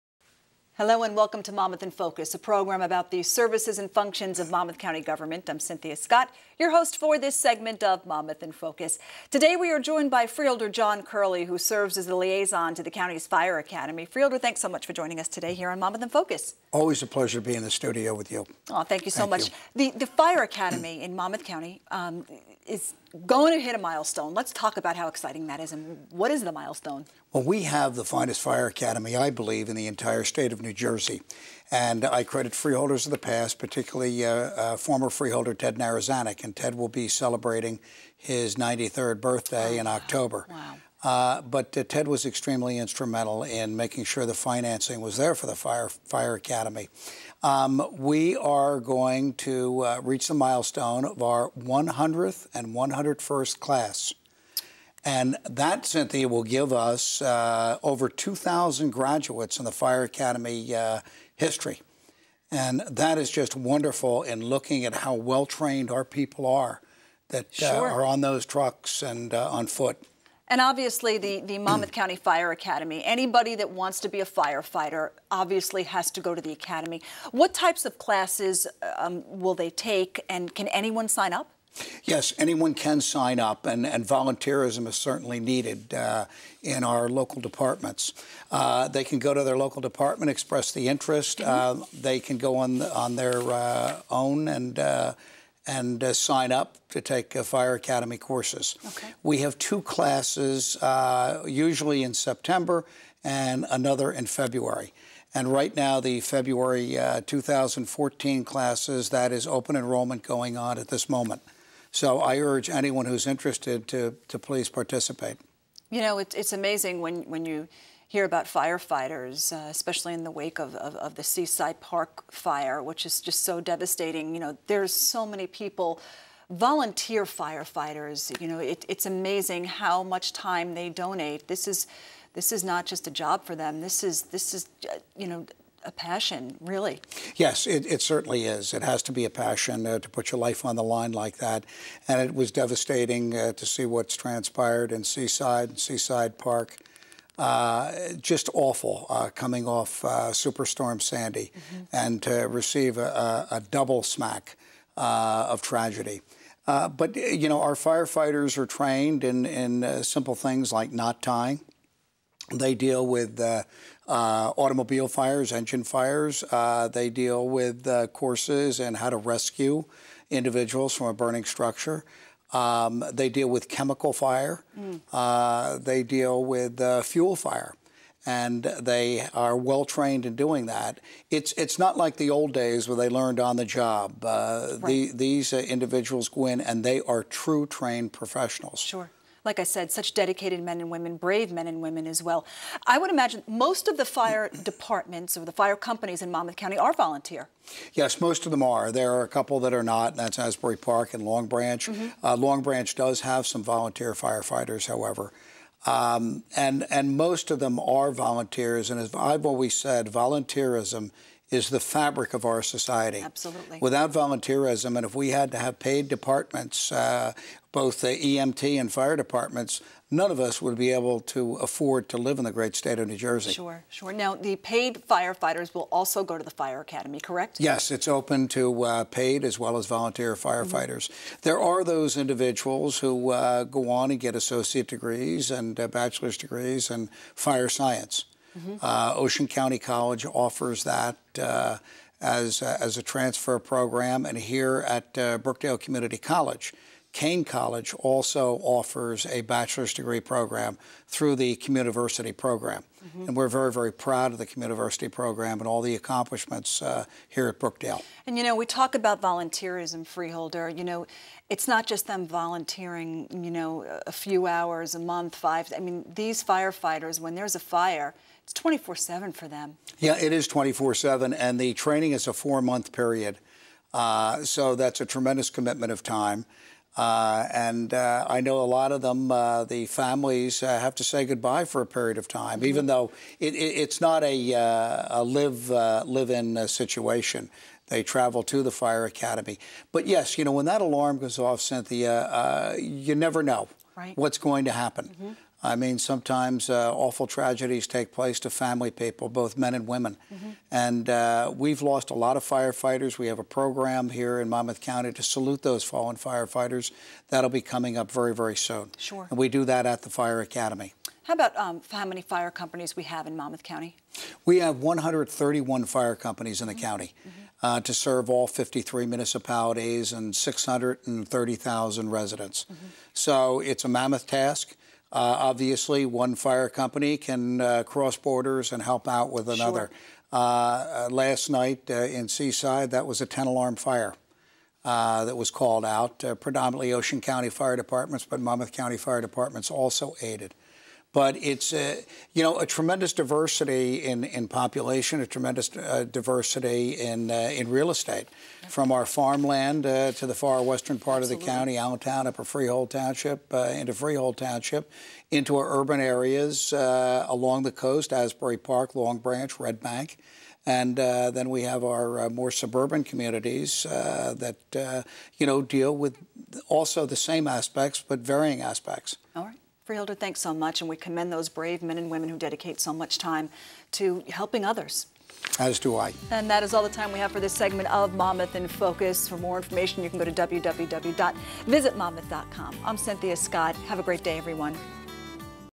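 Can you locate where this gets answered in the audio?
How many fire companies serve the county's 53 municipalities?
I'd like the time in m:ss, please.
5:14.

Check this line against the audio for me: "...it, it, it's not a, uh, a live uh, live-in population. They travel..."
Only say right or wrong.
wrong.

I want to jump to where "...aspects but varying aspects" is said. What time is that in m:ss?
6:07.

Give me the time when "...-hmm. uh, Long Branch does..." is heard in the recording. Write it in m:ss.
3:21.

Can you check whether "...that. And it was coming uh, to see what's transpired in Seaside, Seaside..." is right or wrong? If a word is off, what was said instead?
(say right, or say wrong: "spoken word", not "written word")
wrong: "devastating", not "coming".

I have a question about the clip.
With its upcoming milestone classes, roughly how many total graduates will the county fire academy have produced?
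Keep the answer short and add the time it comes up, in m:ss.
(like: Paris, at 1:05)
over 2,000, at 0:57.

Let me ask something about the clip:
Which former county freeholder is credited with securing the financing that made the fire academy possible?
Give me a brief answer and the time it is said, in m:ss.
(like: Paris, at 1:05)
Ted Narozanick, at 0:35.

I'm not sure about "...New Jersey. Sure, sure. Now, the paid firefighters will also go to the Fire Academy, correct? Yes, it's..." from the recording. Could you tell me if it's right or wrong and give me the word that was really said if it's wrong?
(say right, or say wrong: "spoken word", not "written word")
right.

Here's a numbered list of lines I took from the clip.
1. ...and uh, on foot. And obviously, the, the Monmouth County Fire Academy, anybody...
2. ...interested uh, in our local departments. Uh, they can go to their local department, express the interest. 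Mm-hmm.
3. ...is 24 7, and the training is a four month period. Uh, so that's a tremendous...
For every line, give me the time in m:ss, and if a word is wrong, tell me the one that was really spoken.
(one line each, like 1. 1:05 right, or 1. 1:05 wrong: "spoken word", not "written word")
1. 1:09 right
2. 1:25 wrong: "needed", not "interested"
3. 4:30 right.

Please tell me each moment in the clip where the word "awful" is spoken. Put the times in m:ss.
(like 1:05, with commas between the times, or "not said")
2:28, 4:56.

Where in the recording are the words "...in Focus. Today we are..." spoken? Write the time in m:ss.
0:08.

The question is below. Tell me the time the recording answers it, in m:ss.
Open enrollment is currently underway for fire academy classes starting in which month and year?
1:46.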